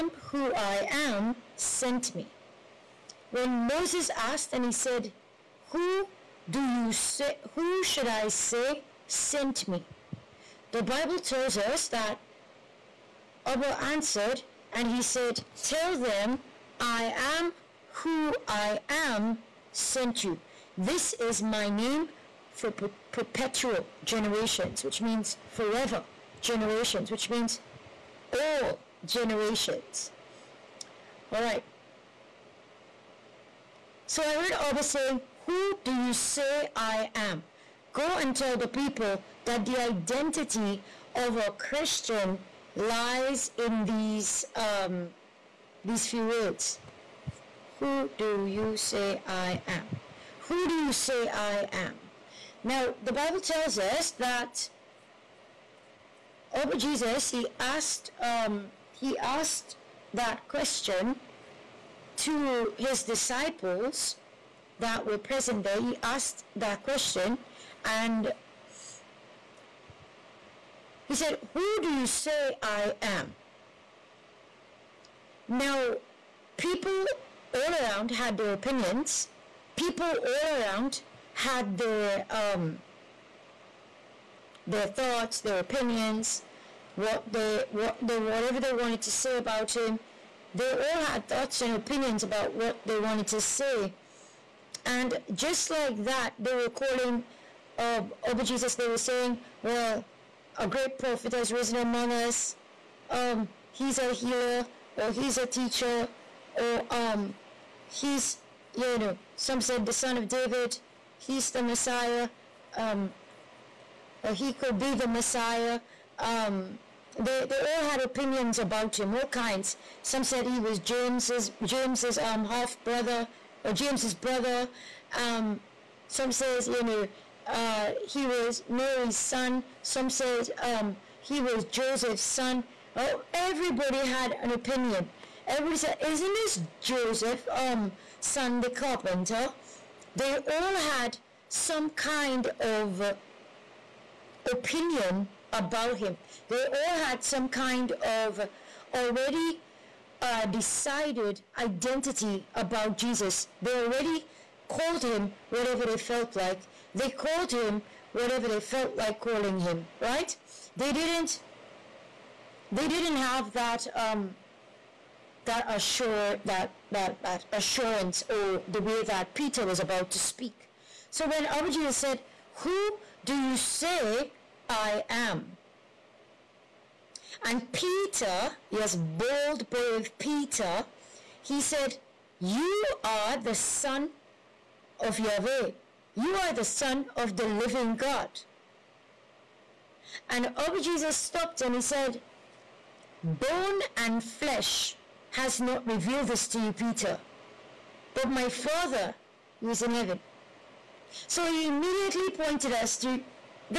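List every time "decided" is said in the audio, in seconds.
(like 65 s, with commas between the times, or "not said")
150 s.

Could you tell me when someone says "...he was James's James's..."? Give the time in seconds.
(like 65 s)
120 s.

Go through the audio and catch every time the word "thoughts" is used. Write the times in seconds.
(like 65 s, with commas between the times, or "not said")
84 s, 91 s.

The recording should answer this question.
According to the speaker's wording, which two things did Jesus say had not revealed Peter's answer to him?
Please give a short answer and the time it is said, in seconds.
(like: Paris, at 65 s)
bone and flesh, at 193 s.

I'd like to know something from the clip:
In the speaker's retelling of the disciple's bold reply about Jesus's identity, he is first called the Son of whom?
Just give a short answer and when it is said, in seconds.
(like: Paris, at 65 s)
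Yahweh, at 185 s.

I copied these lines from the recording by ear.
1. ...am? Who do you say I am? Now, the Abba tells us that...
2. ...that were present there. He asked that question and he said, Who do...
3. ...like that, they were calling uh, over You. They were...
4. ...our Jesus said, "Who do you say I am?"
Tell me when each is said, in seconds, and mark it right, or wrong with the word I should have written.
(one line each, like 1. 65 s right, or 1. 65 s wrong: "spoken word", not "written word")
1. 49 s wrong: "Bible", not "Abba"
2. 64 s right
3. 95 s wrong: "Jesus", not "You"
4. 171 s right.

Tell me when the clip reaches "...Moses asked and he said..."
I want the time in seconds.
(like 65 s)
3 s.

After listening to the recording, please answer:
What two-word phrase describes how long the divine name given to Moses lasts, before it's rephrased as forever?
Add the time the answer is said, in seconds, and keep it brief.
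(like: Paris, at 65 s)
perpetual generations, at 23 s.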